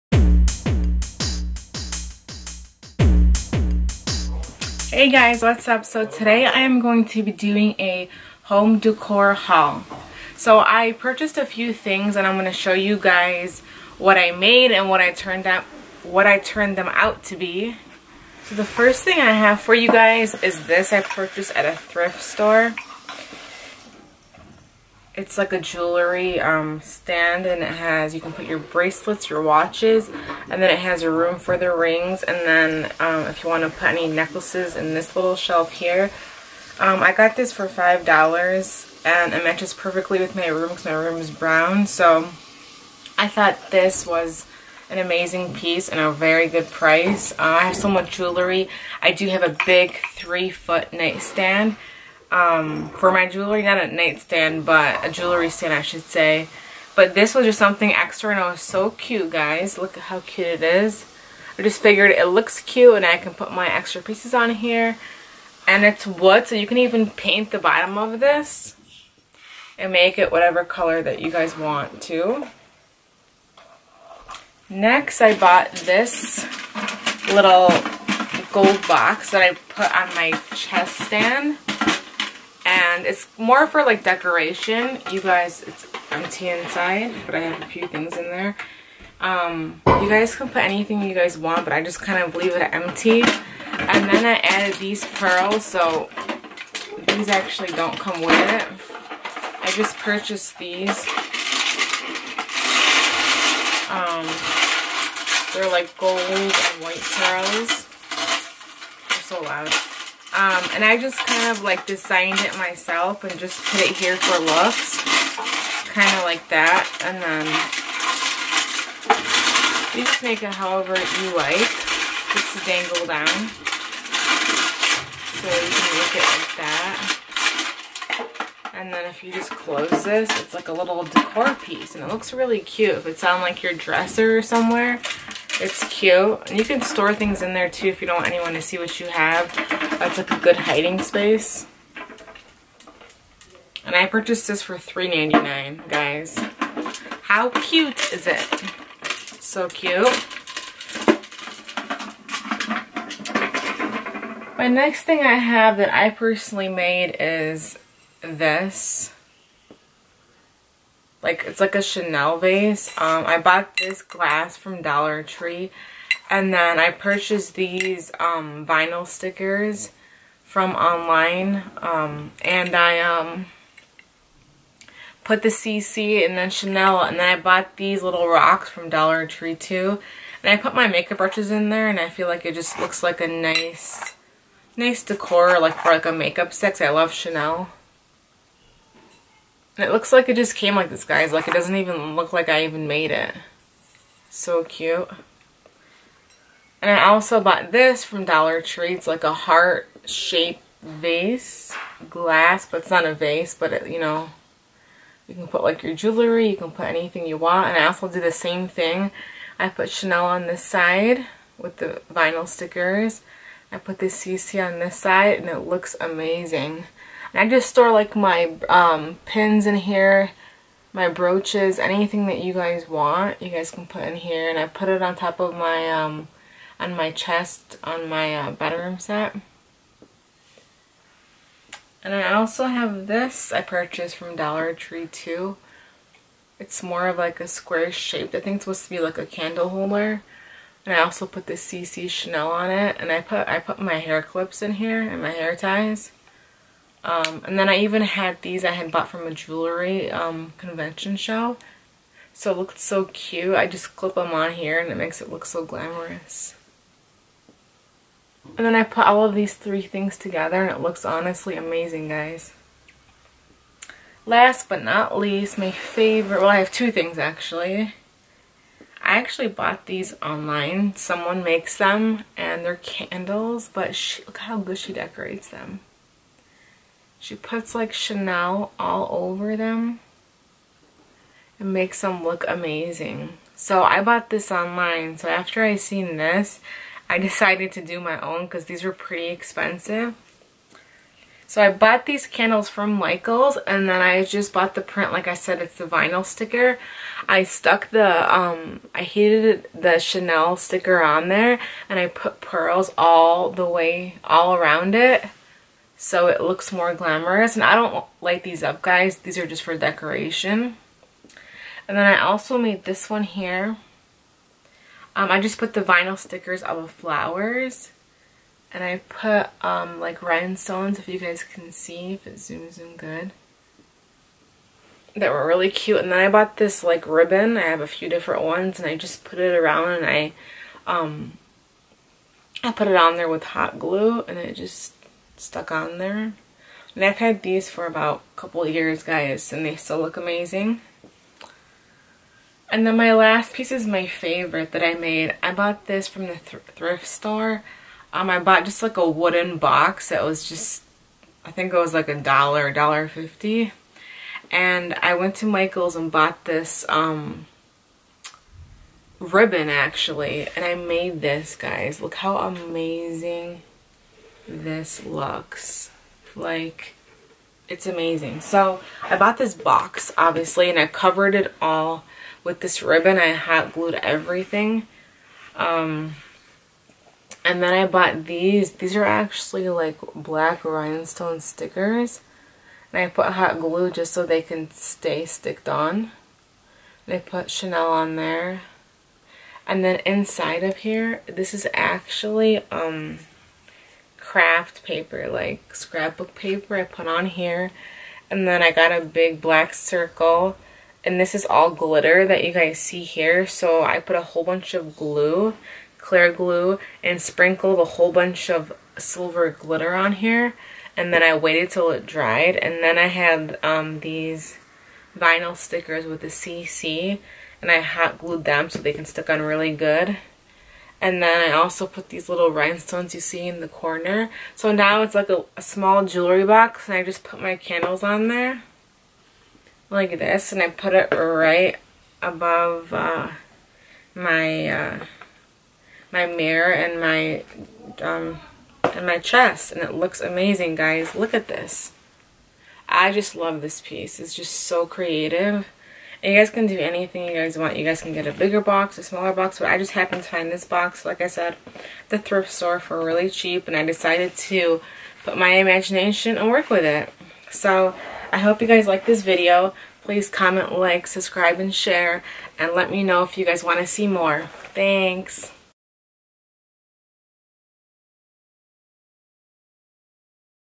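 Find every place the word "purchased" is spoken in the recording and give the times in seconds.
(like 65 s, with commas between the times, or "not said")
10 s, 20 s, 99 s, 144 s, 166 s, 233 s.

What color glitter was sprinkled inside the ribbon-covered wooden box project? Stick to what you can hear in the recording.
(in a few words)
silver.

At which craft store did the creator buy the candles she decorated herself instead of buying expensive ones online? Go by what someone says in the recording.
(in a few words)
Michaels.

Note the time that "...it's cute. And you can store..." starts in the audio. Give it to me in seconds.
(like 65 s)
135 s.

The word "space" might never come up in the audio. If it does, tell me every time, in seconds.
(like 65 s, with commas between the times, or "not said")
140 s.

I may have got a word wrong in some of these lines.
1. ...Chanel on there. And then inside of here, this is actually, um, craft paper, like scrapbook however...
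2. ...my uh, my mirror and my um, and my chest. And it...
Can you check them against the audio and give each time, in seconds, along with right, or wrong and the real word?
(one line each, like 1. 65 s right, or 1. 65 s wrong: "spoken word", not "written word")
1. 387 s wrong: "paper", not "however"
2. 434 s right.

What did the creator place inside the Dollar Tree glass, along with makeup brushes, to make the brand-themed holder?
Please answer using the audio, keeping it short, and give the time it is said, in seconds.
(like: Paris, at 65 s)
little rocks, at 178 s.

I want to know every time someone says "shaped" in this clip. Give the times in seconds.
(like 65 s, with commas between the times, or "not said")
199 s, 237 s.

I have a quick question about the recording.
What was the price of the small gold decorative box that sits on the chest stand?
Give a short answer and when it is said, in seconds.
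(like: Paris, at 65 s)
$3.99, at 144 s.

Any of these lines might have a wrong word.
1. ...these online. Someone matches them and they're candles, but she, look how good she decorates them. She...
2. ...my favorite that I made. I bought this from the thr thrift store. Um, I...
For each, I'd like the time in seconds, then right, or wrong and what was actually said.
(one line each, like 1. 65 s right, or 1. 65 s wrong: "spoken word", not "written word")
1. 269 s wrong: "makes", not "matches"
2. 343 s right.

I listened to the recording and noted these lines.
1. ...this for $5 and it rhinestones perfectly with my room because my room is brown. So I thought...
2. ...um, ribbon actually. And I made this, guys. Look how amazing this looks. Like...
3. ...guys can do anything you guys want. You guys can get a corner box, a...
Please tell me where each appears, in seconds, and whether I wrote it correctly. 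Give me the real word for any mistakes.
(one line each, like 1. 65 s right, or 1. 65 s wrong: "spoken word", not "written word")
1. 37 s wrong: "matches", not "rhinestones"
2. 356 s right
3. 446 s wrong: "bigger", not "corner".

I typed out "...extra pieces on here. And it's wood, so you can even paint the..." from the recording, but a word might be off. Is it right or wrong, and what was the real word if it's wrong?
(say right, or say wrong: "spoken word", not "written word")
right.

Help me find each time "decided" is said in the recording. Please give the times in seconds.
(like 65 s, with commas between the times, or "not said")
287 s, 453 s.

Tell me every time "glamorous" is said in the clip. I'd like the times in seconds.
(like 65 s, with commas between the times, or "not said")
255 s, 306 s.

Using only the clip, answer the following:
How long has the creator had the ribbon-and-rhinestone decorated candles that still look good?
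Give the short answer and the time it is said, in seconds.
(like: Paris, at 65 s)
a couple years, at 338 s.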